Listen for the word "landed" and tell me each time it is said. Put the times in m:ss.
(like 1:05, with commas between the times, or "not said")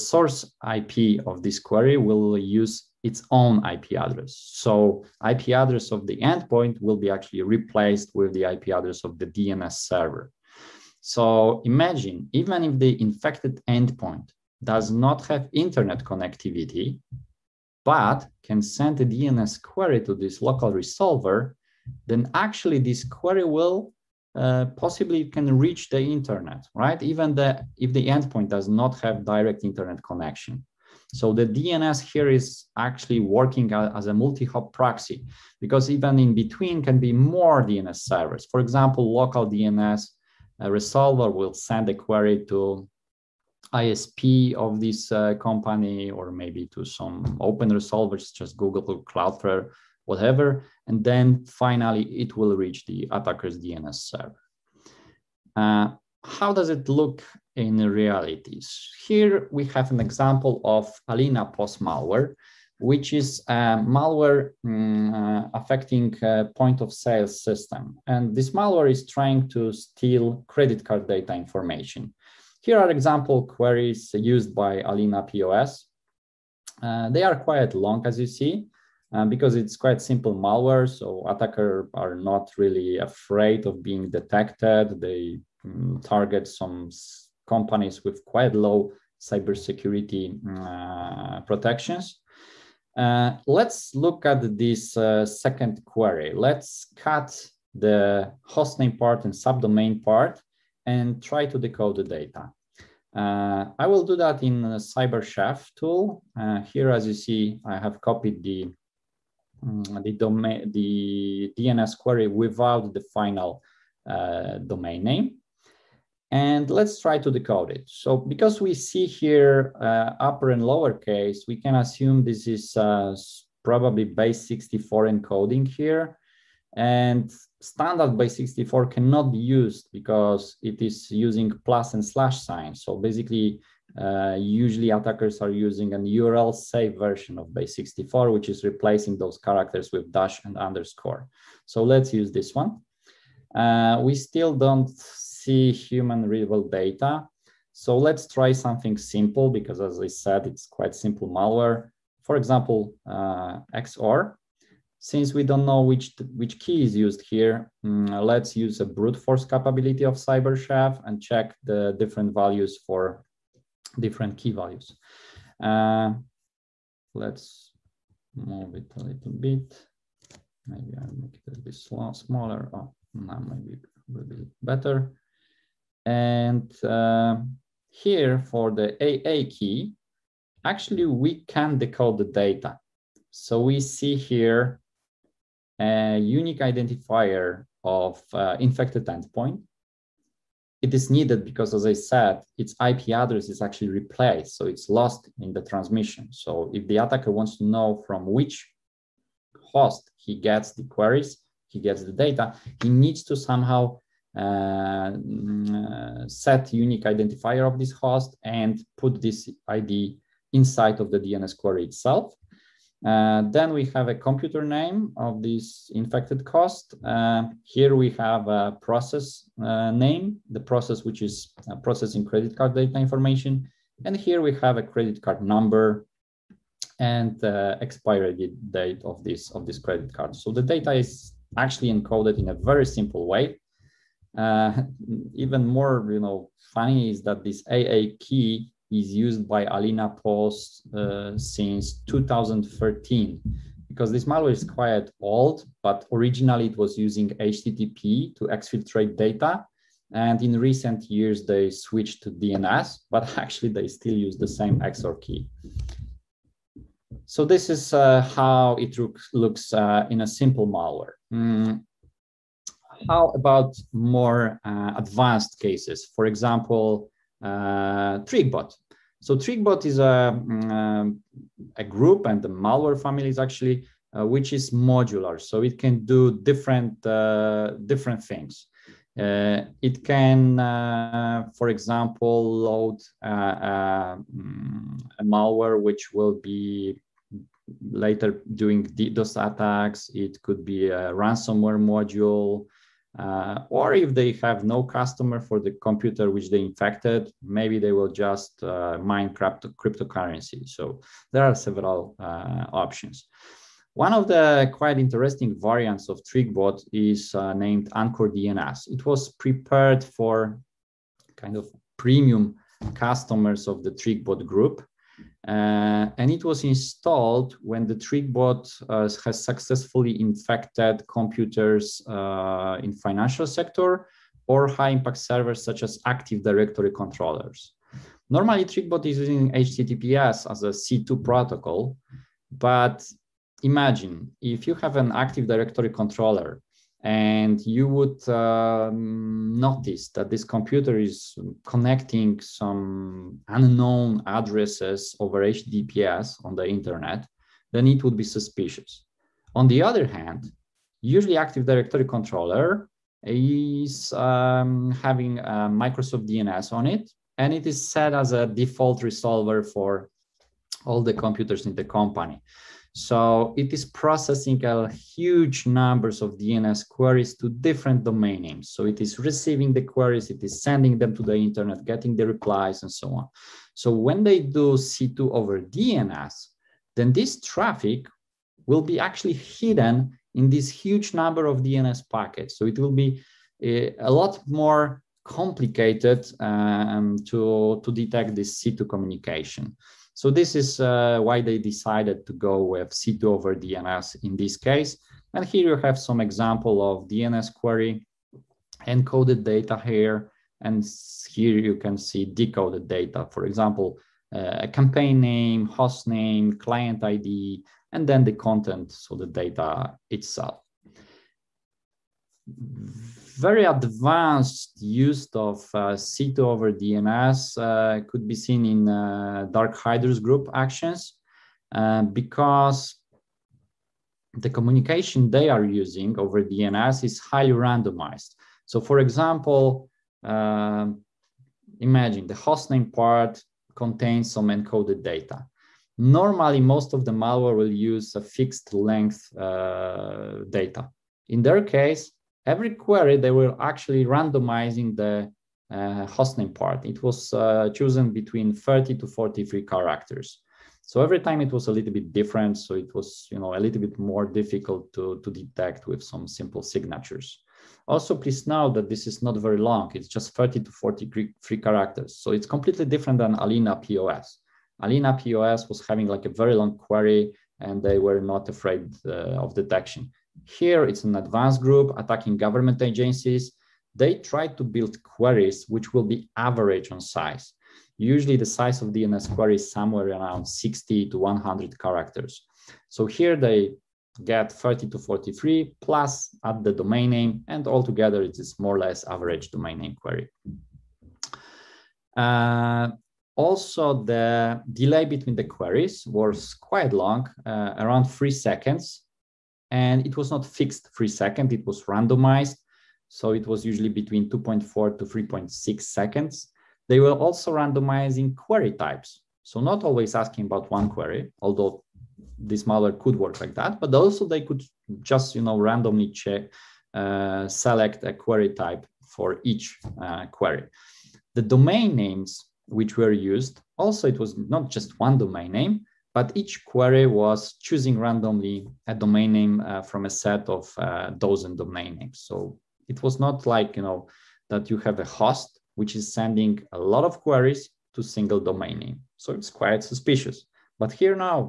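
not said.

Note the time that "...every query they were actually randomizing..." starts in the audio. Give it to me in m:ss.
7:22.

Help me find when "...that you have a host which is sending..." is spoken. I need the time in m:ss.
8:54.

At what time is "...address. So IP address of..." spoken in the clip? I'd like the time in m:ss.
0:04.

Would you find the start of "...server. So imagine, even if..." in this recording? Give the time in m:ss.
0:09.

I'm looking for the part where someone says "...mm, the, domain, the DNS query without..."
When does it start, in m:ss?
1:49.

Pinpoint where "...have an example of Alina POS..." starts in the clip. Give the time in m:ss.
0:59.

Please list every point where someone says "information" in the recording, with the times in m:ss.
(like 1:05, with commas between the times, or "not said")
1:11, 3:42.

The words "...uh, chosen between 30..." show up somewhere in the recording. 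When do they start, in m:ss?
7:27.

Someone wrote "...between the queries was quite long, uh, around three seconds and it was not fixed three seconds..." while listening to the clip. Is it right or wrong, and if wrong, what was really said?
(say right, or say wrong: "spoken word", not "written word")
right.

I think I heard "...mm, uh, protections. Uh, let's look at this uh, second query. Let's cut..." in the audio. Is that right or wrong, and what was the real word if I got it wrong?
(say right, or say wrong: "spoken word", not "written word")
right.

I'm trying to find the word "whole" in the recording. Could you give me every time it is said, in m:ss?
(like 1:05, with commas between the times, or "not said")
not said.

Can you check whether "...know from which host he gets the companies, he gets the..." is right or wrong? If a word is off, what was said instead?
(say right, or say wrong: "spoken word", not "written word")
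wrong: "queries", not "companies".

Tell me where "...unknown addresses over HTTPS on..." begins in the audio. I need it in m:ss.
5:43.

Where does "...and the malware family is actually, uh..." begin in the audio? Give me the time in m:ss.
4:32.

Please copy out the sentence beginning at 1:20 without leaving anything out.
So attackers are not really afraid of being detected.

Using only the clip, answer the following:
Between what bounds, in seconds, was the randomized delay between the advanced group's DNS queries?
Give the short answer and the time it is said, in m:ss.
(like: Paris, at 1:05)
2.4 to 3.6 seconds, at 8:24.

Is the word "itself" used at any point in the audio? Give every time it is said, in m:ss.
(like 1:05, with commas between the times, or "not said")
3:31, 6:50.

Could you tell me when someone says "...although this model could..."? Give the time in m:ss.
8:31.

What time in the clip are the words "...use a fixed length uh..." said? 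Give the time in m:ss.
7:17.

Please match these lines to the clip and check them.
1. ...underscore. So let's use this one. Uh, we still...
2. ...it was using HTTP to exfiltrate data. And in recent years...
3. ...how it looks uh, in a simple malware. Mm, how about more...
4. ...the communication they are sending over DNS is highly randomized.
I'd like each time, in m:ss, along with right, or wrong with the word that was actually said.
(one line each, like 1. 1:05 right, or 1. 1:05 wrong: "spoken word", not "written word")
1. 2:20 right
2. 4:06 right
3. 4:18 right
4. 7:04 wrong: "using", not "sending".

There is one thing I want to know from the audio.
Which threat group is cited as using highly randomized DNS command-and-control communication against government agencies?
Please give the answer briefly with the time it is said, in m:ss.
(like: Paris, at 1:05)
DarkHydrus, at 6:59.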